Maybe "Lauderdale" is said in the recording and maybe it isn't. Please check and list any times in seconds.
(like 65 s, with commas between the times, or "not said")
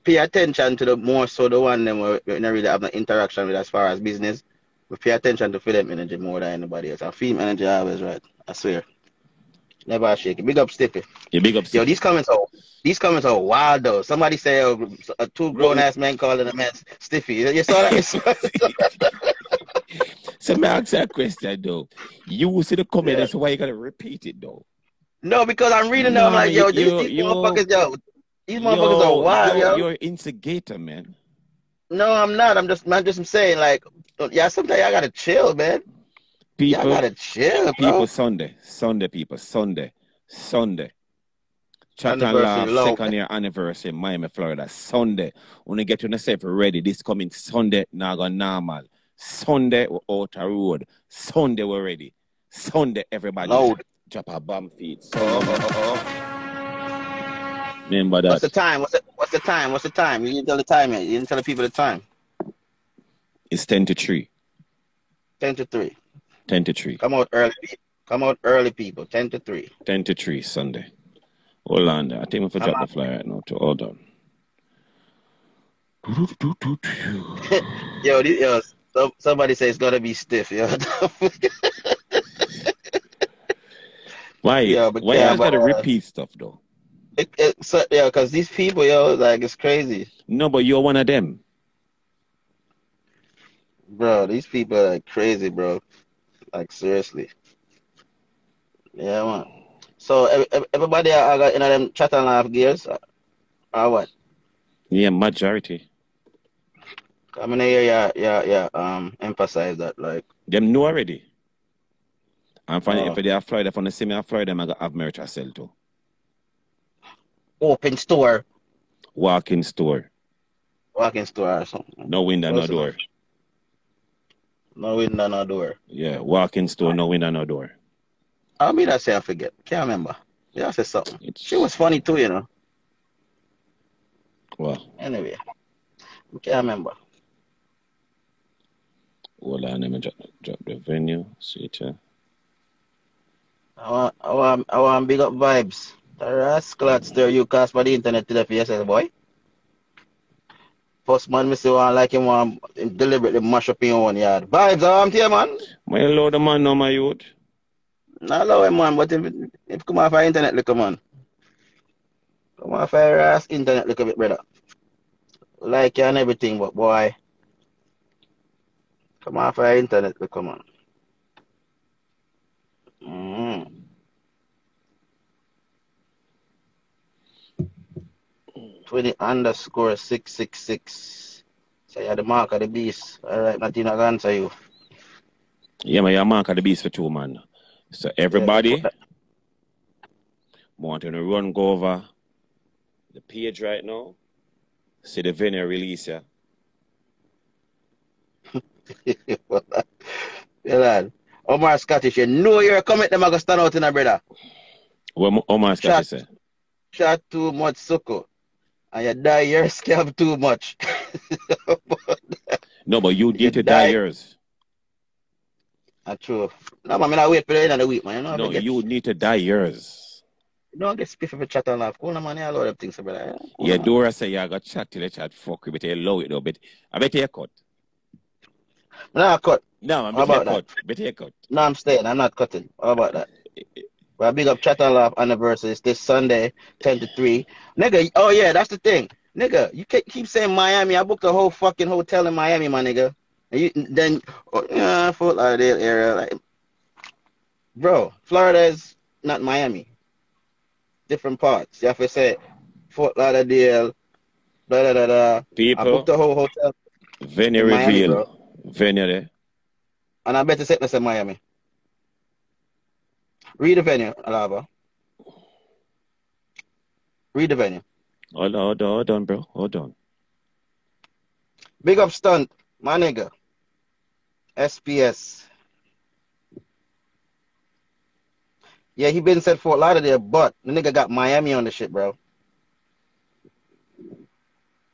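245 s, 253 s, 279 s.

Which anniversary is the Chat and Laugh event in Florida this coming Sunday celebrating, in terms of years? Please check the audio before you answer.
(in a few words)
2nd.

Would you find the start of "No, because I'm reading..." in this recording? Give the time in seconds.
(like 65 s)
25 s.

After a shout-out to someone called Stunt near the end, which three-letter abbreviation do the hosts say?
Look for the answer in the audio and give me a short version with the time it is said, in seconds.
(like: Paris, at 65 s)
SBS, at 274 s.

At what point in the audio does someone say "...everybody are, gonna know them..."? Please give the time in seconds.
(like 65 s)
100 s.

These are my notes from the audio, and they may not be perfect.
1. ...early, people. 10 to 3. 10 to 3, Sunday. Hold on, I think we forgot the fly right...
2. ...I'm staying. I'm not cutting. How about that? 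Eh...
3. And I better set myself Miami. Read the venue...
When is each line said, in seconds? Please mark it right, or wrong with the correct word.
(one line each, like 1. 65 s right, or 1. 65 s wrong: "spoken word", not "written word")
1. 68 s right
2. 231 s right
3. 260 s right.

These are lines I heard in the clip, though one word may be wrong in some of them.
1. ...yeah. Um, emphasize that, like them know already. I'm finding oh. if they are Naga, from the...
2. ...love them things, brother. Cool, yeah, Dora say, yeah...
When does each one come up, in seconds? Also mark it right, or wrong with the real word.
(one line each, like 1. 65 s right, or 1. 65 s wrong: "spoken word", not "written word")
1. 108 s wrong: "Florida", not "Naga"
2. 222 s right.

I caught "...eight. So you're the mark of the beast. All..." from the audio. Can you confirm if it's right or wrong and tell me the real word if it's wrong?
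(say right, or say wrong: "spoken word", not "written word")
wrong: "six", not "eight".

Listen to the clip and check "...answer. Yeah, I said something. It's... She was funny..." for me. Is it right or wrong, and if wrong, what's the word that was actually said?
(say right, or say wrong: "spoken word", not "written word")
wrong: "remember", not "answer".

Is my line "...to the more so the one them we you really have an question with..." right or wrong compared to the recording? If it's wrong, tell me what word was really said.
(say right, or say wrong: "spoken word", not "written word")
wrong: "interaction", not "question".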